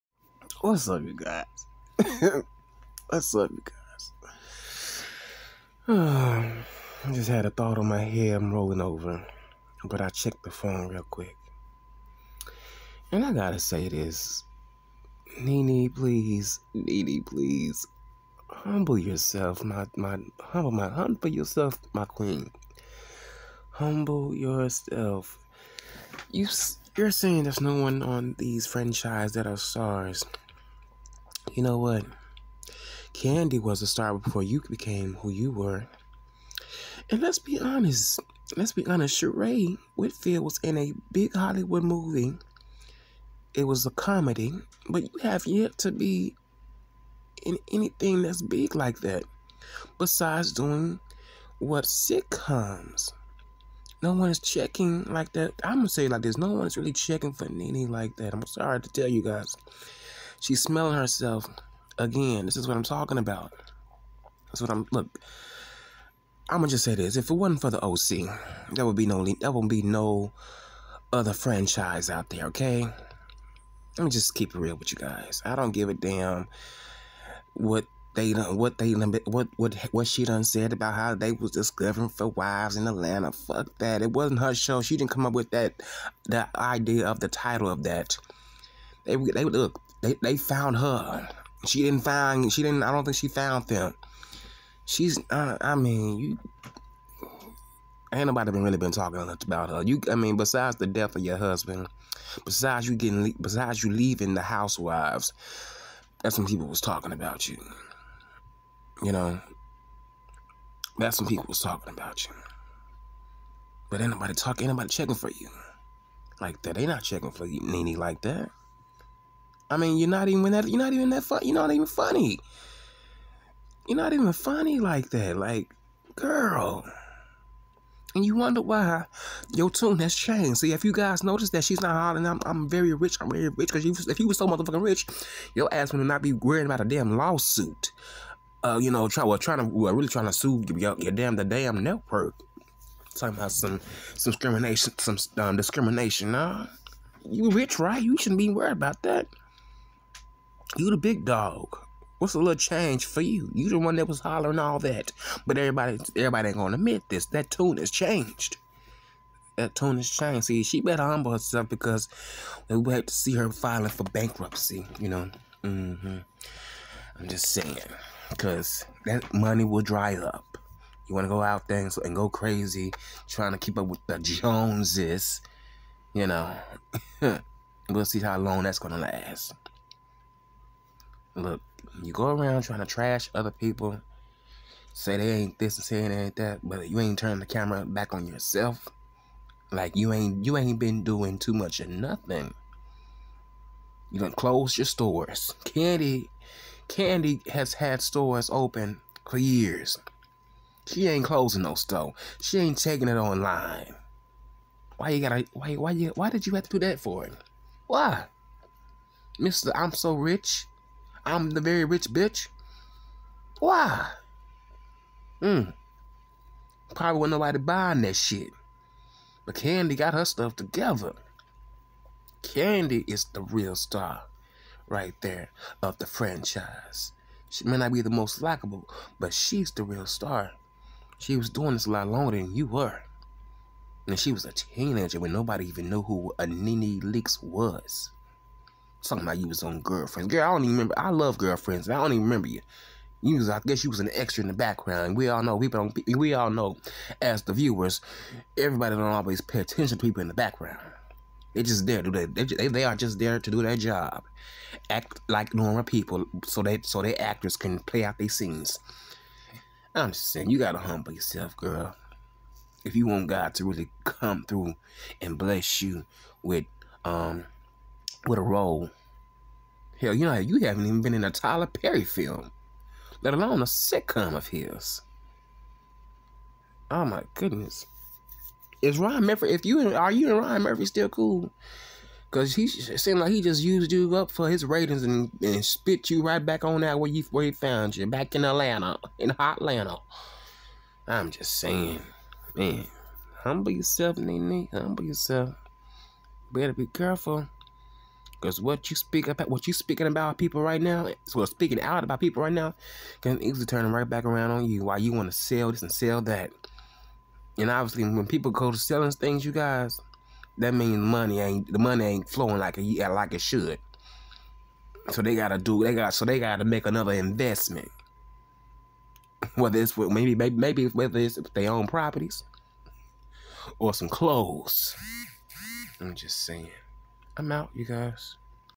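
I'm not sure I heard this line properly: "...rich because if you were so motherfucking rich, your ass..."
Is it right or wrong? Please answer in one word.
right.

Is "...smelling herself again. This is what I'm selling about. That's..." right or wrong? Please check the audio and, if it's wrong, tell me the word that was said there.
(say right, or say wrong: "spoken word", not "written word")
wrong: "talking", not "selling".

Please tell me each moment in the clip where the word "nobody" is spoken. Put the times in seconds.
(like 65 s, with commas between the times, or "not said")
98 s, 114 s, 217 s, 235 s.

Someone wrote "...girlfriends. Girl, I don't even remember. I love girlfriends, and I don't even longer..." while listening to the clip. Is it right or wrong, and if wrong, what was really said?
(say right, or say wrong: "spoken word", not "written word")
wrong: "remember", not "longer".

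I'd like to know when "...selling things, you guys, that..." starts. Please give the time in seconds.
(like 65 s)
308 s.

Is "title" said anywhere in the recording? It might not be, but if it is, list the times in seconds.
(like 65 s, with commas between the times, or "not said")
87 s.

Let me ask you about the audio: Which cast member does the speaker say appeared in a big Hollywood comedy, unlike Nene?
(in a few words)
Sheree Whitfield.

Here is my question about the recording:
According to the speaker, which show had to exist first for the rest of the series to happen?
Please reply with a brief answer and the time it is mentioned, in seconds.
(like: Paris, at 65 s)
the OC, at 67 s.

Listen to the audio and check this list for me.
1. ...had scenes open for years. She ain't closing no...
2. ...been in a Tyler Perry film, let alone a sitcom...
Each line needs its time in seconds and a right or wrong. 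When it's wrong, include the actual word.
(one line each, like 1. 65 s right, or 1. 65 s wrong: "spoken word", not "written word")
1. 197 s wrong: "stores", not "scenes"
2. 271 s right.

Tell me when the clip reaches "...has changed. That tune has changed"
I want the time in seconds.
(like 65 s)
157 s.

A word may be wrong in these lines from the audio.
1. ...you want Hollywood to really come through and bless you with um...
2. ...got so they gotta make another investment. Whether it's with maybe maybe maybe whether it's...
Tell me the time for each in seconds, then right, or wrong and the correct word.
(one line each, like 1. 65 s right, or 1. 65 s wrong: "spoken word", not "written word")
1. 262 s wrong: "God", not "Hollywood"
2. 315 s right.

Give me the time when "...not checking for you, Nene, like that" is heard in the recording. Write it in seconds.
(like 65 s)
116 s.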